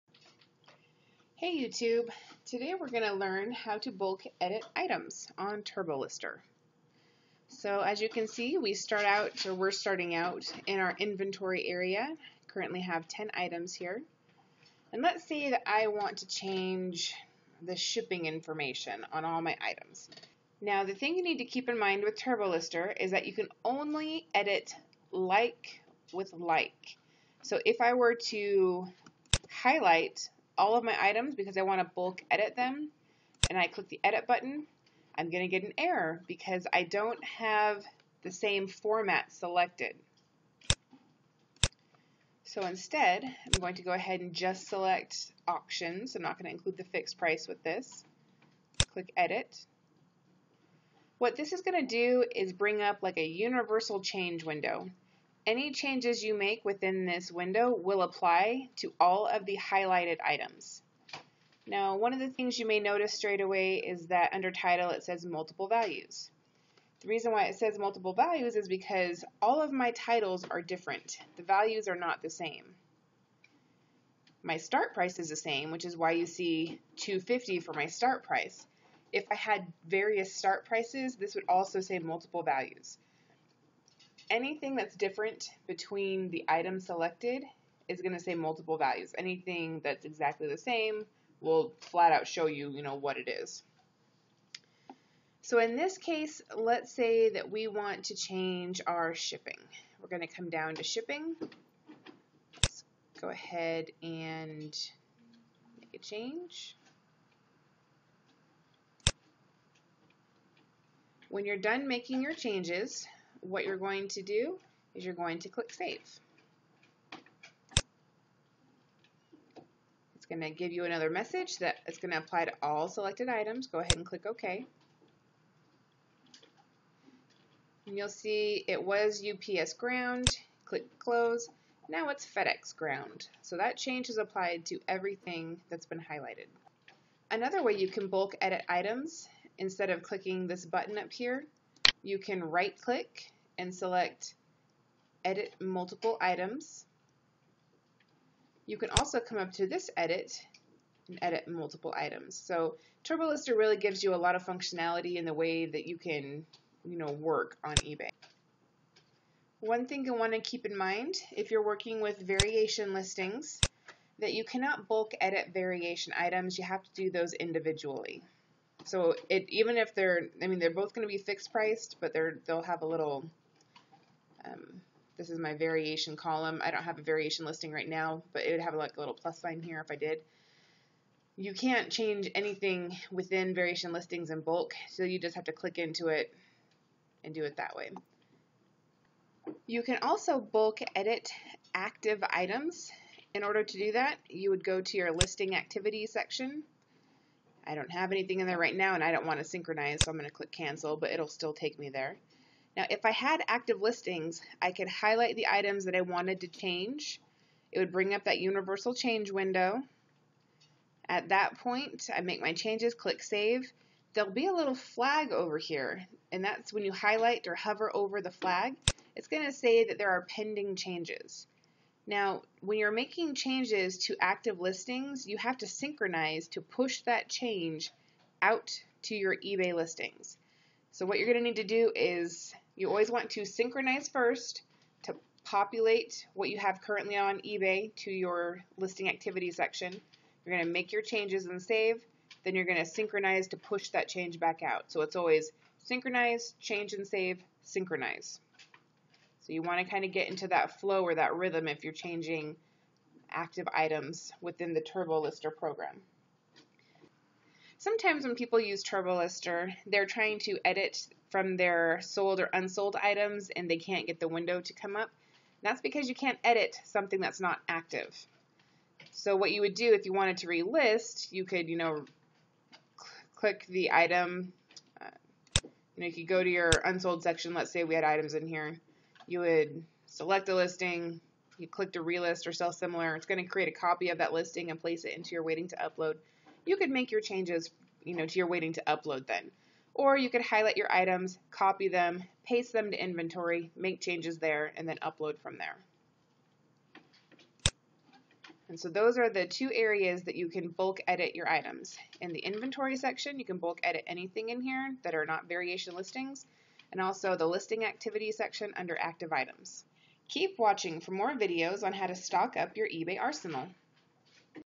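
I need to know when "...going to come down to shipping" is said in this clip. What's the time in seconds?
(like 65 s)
100 s.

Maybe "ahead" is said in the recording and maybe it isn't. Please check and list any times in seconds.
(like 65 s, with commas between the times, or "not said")
43 s, 103 s, 123 s.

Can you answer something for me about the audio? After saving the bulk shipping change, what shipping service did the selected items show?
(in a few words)
FedEx Ground.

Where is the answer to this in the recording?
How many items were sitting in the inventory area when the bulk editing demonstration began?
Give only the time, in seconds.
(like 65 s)
13 s.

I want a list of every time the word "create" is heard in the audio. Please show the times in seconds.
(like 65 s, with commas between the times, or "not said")
283 s.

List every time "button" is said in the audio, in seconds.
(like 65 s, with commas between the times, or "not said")
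34 s, 140 s.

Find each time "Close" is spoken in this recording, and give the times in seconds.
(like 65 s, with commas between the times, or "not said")
130 s.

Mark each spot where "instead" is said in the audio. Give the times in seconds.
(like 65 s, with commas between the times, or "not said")
42 s, 139 s.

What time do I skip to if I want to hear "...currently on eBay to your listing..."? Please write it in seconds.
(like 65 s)
236 s.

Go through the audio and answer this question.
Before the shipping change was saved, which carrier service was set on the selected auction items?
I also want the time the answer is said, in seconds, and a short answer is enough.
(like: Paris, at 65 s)
UPS Ground, at 129 s.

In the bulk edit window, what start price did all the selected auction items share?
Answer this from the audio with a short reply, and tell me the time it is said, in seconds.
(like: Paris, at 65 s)
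250, at 76 s.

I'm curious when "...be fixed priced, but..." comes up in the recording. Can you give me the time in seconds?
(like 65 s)
171 s.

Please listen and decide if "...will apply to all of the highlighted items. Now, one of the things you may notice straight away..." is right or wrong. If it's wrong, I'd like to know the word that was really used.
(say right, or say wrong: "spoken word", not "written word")
right.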